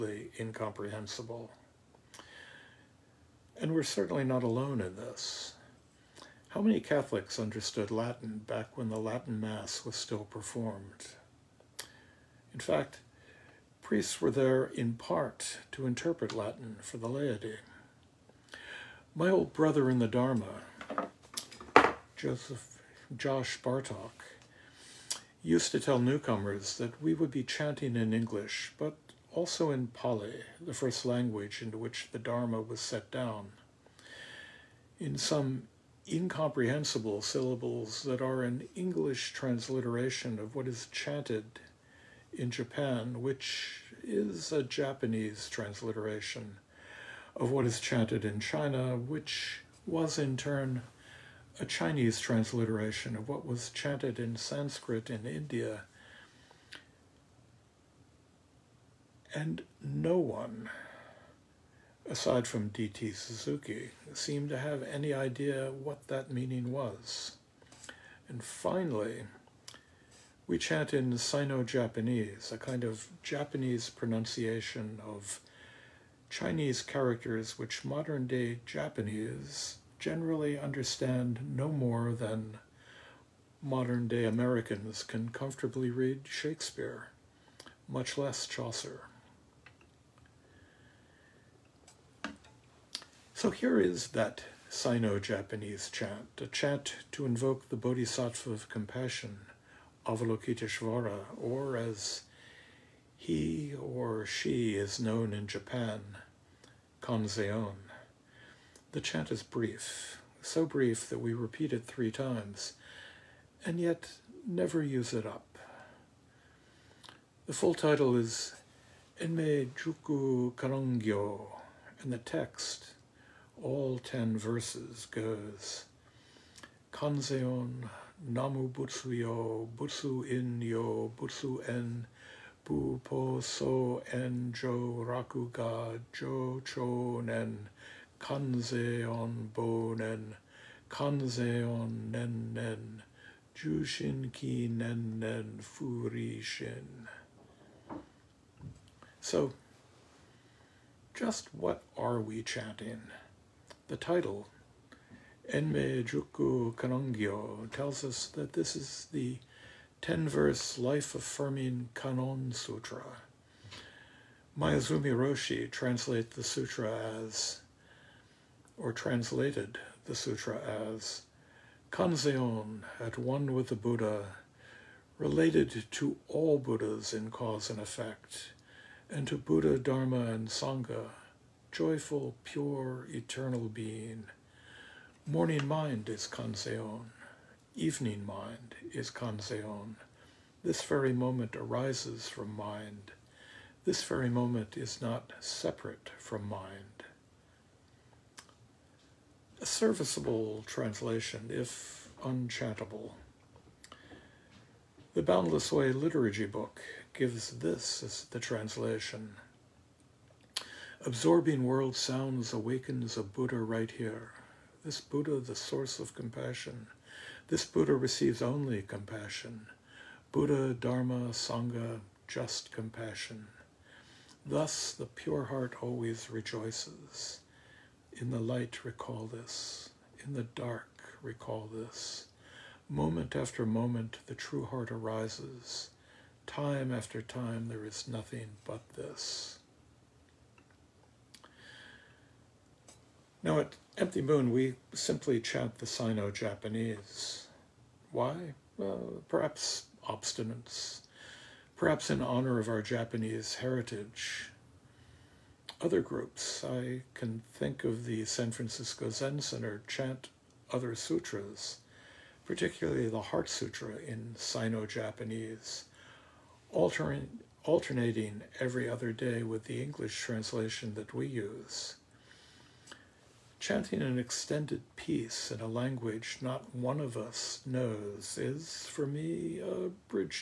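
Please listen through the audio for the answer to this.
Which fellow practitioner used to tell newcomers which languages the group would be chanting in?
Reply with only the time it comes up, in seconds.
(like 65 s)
22 s.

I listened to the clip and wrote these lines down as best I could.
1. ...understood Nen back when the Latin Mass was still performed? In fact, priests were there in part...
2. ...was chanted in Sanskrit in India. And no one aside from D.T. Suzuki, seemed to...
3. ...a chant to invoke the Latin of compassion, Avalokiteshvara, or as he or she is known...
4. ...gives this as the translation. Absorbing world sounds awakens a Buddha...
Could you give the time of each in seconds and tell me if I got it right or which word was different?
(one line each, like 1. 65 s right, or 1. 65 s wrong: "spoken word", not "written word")
1. 7 s wrong: "Latin", not "Nen"
2. 53 s right
3. 96 s wrong: "Bodhisattva", not "Latin"
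4. 207 s right.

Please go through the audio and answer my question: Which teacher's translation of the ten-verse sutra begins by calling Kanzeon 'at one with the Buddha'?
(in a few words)
Maezumi Roshi.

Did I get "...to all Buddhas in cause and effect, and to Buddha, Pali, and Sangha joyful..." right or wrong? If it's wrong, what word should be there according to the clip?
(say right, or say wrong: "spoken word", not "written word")
wrong: "Dharma", not "Pali".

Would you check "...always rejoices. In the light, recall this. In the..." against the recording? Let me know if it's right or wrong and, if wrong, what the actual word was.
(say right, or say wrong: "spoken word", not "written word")
right.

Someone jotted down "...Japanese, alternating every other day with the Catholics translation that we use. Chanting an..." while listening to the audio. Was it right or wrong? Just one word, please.
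wrong.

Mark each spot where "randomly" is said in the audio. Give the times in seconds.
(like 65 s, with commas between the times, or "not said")
not said.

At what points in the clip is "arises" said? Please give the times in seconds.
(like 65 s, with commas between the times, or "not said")
191 s, 234 s.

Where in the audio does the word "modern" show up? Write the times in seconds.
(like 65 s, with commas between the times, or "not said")
77 s, 83 s.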